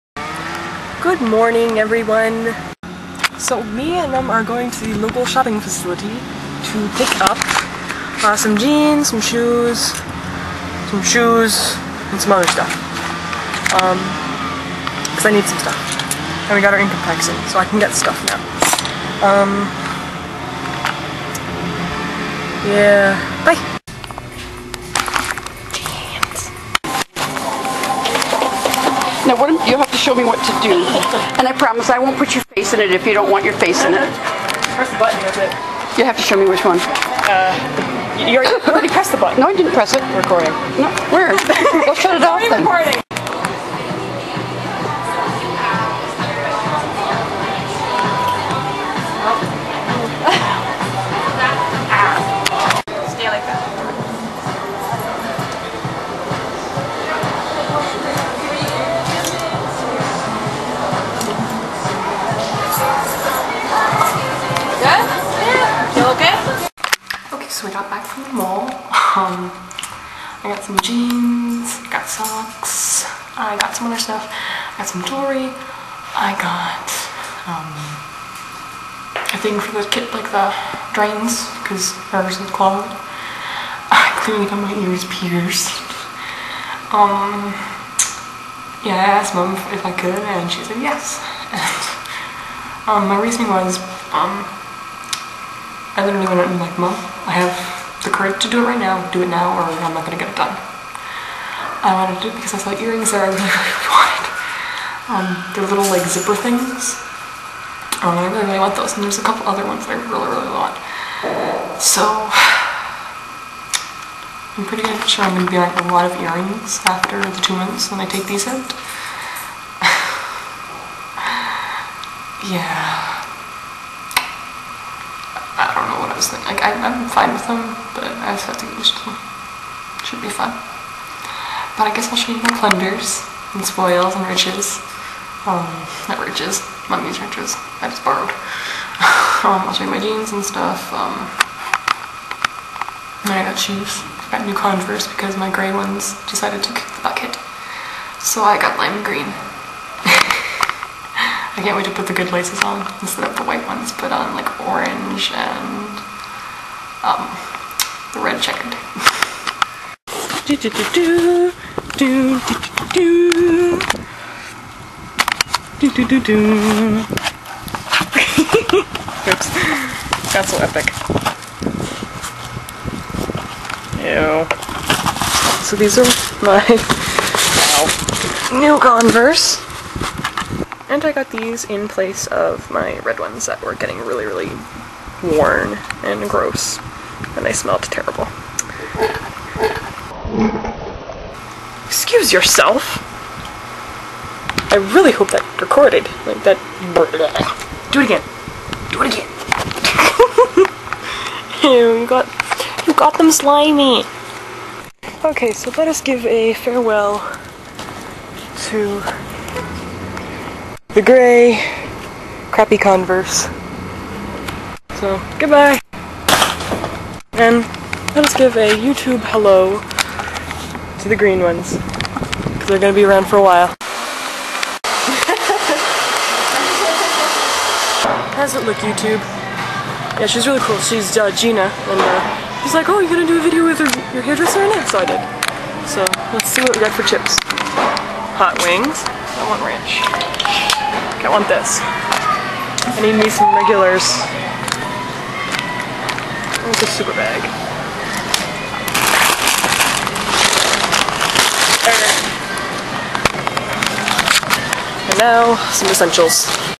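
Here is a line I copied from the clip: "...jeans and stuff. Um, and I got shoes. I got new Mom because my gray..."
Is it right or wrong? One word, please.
wrong.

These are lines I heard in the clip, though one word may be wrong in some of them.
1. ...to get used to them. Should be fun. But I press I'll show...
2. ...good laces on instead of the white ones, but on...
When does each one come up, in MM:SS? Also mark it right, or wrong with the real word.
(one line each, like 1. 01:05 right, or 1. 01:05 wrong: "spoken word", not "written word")
1. 02:08 wrong: "guess", not "press"
2. 02:32 right.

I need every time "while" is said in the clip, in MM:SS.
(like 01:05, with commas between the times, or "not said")
03:43.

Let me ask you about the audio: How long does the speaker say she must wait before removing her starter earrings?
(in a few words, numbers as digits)
Two months.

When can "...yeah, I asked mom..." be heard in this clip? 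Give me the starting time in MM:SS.
01:28.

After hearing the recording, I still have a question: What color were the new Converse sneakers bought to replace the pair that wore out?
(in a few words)
Lime green.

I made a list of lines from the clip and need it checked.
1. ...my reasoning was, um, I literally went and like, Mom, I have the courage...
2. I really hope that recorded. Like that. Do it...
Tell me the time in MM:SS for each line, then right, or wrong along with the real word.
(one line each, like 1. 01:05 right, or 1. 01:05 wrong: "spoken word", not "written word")
1. 01:33 right
2. 03:14 right.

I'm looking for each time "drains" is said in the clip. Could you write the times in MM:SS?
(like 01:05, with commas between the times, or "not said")
01:20.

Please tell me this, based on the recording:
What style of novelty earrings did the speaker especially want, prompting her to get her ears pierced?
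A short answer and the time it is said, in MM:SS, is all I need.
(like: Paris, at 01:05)
Zipper things, at 01:46.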